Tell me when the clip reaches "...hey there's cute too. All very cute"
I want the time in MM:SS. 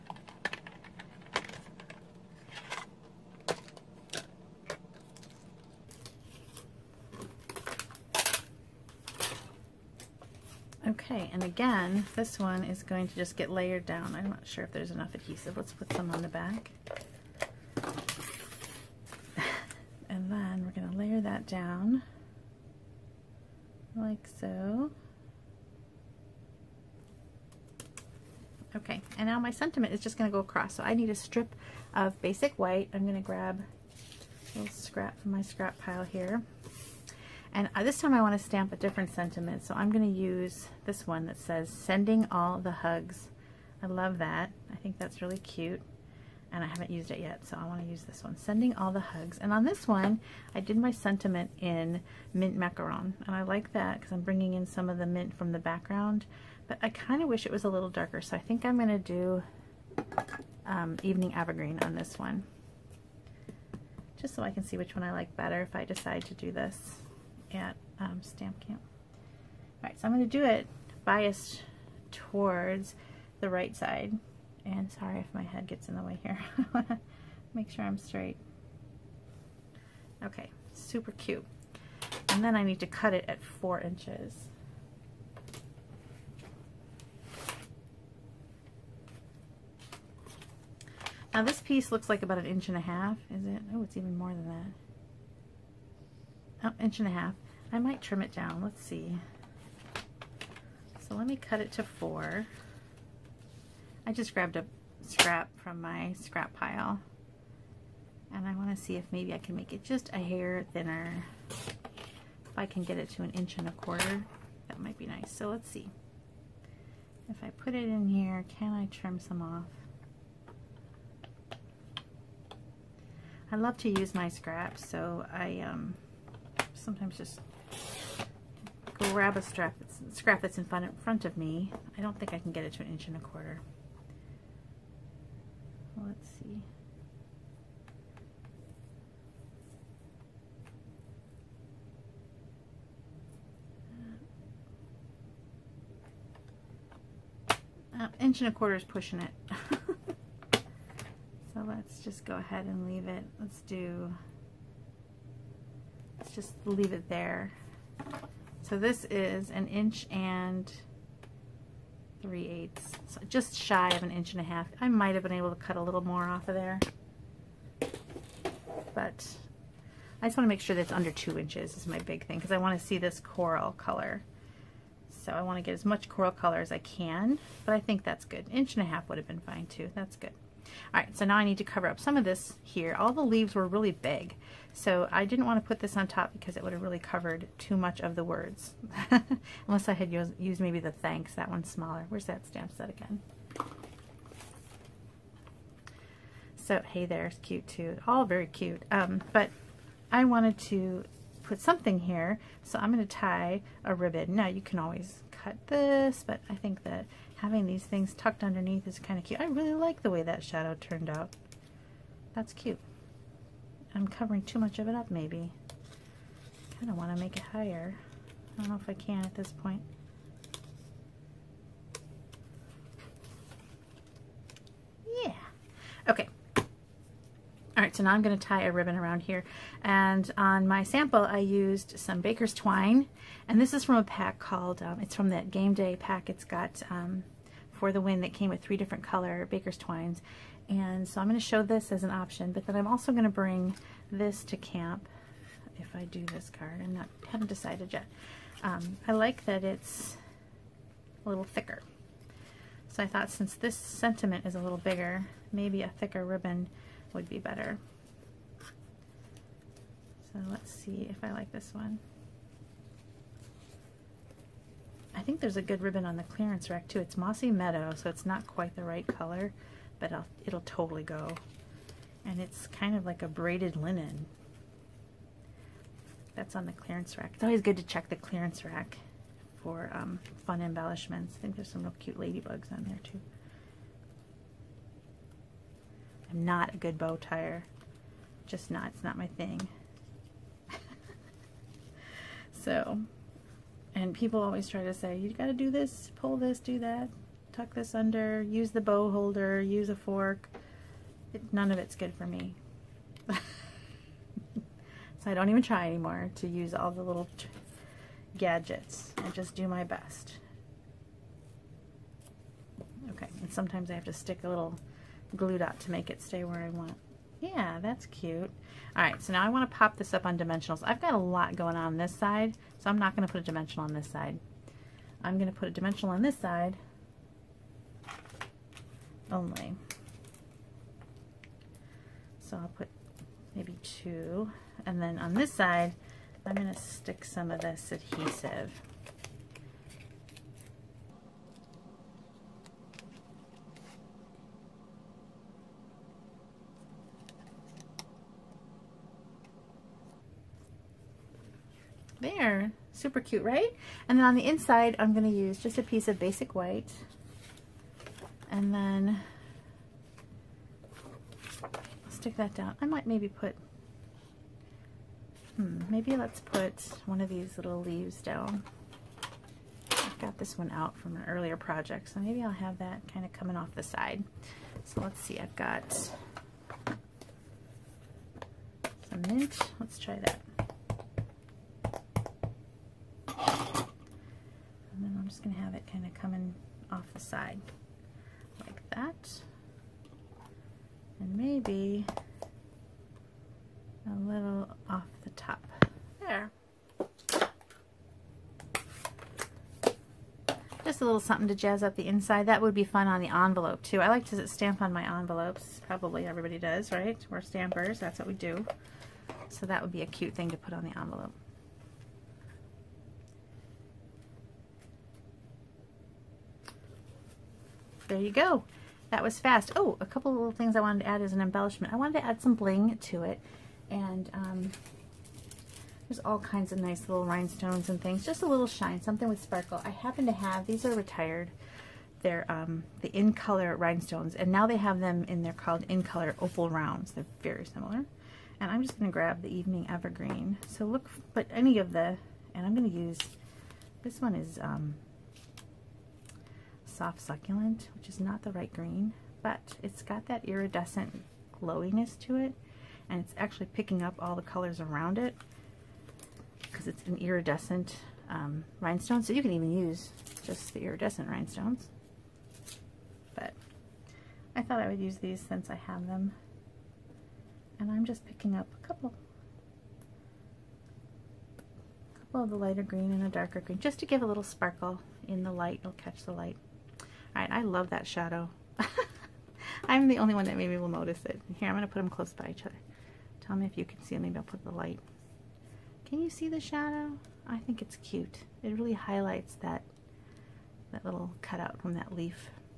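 03:16.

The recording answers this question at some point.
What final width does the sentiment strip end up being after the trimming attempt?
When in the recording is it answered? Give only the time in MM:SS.
02:39.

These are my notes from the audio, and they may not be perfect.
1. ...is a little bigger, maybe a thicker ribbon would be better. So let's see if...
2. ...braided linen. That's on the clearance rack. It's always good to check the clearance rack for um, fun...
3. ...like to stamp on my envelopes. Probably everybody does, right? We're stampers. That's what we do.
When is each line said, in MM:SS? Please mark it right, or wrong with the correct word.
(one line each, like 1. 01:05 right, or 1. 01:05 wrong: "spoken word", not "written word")
1. 04:14 right
2. 04:33 right
3. 06:44 right.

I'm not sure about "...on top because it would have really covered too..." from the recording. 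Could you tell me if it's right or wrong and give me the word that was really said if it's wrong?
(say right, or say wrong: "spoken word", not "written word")
right.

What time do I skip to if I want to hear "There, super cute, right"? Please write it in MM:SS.
05:52.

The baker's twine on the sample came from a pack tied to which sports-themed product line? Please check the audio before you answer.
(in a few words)
Game Day.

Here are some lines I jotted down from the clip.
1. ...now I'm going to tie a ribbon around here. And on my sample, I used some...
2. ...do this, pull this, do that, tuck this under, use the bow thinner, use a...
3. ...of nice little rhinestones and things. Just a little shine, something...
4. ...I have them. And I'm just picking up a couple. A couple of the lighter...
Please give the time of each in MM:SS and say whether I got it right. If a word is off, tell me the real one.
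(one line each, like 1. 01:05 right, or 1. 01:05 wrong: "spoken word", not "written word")
1. 03:48 right
2. 04:55 wrong: "holder", not "thinner"
3. 07:06 right
4. 07:45 right.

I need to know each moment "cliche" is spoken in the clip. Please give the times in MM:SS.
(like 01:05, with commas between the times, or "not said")
not said.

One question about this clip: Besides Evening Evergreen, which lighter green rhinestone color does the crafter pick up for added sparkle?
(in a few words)
Soft Succulent.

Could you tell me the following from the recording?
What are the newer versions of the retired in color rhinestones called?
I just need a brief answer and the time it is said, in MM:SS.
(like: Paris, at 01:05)
In Color Opal Rounds, at 07:15.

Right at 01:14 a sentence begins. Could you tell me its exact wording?
And sorry if my head gets in the way here.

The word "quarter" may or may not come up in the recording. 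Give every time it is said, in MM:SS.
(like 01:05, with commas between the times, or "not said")
01:53, 02:13, 02:28.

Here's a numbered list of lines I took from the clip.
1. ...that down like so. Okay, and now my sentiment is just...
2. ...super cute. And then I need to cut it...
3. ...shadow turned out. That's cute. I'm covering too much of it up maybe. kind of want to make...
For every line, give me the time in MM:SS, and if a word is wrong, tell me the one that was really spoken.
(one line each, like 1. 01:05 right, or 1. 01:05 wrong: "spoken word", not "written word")
1. 00:21 right
2. 01:20 right
3. 03:30 right.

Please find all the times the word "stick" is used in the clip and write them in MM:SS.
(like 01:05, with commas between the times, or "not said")
05:14, 05:36, 06:02.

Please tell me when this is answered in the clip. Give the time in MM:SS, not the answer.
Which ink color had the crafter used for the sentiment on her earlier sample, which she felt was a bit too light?
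00:52.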